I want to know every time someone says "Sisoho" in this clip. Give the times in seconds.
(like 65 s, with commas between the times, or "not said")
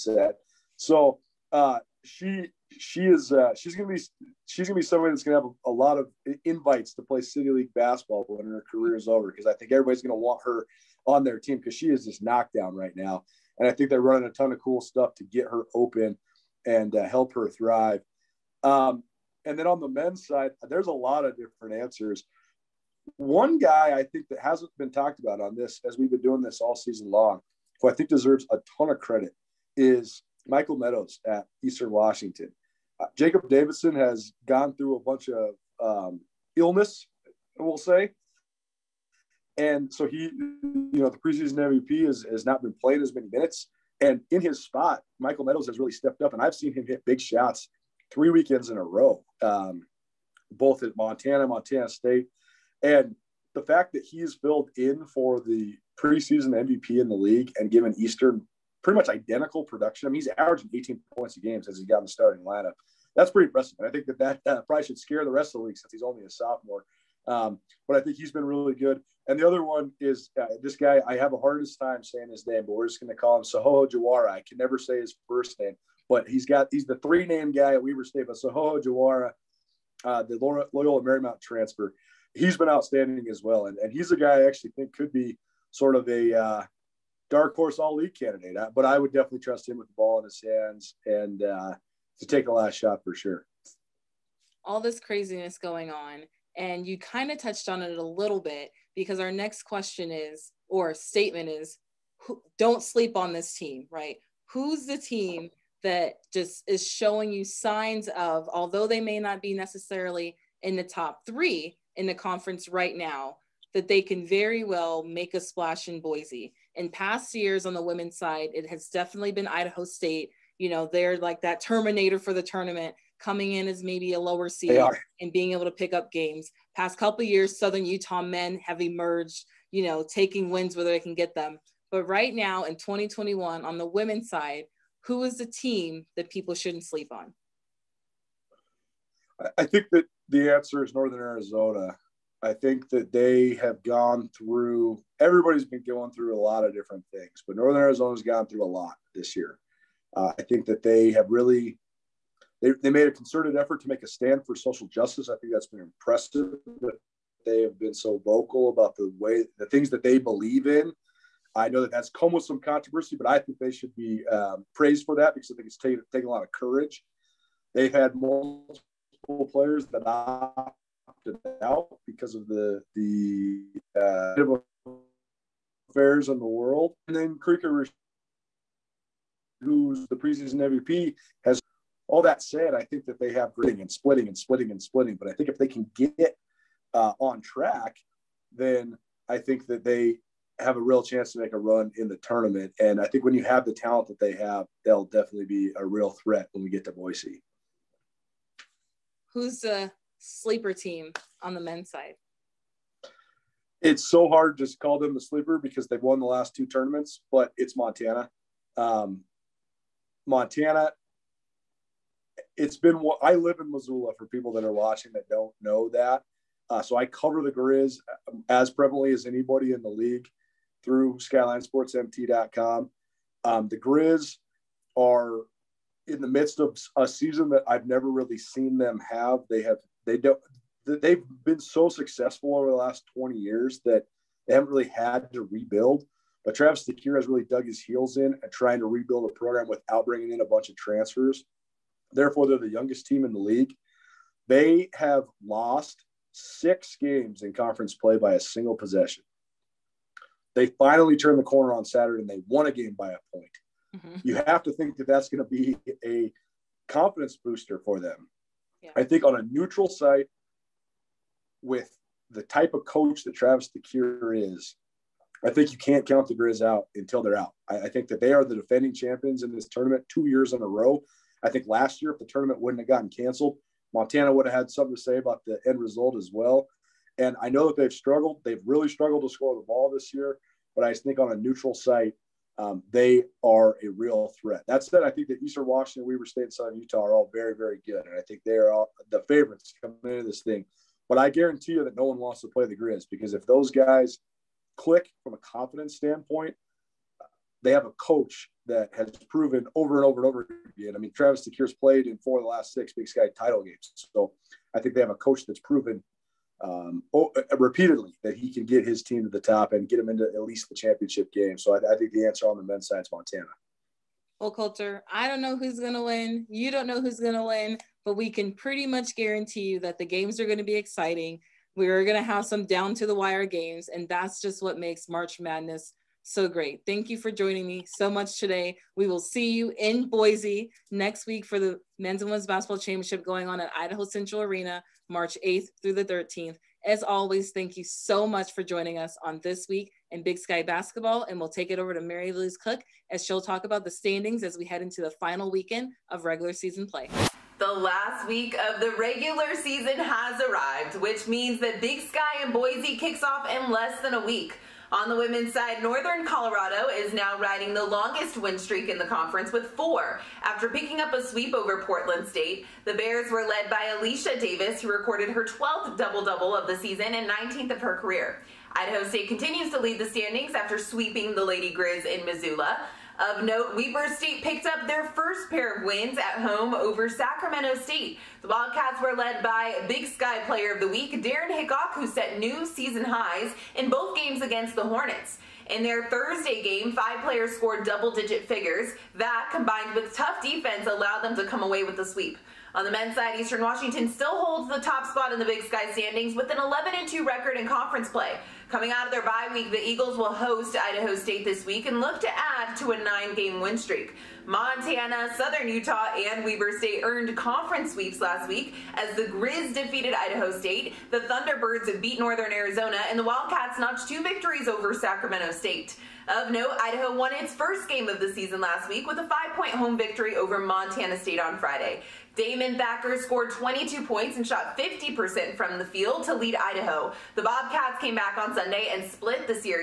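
73 s, 78 s.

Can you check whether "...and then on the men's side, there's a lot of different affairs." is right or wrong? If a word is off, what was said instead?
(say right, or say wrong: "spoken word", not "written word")
wrong: "answers", not "affairs".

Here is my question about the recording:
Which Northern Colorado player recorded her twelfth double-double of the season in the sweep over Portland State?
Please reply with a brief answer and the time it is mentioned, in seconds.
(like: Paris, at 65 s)
Alicia Davis, at 363 s.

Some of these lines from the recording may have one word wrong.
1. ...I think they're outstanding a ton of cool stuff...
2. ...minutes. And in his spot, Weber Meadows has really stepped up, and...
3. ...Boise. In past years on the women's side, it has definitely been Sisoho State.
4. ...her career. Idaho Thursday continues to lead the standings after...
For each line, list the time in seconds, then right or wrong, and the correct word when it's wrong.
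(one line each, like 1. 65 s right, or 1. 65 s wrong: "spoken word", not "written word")
1. 13 s wrong: "running", not "outstanding"
2. 43 s wrong: "Michael", not "Weber"
3. 116 s wrong: "Idaho", not "Sisoho"
4. 367 s wrong: "State", not "Thursday".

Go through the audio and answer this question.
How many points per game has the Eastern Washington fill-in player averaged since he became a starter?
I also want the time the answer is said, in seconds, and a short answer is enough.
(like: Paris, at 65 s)
18, at 60 s.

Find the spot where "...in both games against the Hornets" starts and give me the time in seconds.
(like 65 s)
383 s.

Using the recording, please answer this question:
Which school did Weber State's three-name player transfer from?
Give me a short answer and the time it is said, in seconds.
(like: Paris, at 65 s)
Loyola Marymount, at 80 s.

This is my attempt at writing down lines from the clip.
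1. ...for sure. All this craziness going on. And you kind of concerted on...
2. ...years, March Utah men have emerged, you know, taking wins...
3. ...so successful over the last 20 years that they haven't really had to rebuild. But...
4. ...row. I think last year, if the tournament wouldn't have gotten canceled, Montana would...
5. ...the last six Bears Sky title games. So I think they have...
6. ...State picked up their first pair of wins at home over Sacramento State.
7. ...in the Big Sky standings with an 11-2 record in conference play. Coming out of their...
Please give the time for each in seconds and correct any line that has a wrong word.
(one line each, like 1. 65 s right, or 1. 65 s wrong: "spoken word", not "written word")
1. 93 s wrong: "touched", not "concerted"
2. 127 s wrong: "Southern", not "March"
3. 231 s right
4. 270 s right
5. 302 s wrong: "Big", not "Bears"
6. 374 s right
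7. 395 s right.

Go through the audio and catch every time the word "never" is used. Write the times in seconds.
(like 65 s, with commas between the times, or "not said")
74 s, 227 s.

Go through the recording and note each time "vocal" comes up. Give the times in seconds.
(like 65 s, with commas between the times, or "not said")
158 s.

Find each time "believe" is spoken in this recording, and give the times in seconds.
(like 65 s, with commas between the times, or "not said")
160 s.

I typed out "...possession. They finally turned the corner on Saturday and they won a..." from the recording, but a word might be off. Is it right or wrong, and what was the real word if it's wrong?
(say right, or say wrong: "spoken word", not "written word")
right.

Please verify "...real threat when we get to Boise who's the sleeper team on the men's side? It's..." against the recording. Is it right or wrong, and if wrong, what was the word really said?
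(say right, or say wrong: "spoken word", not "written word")
right.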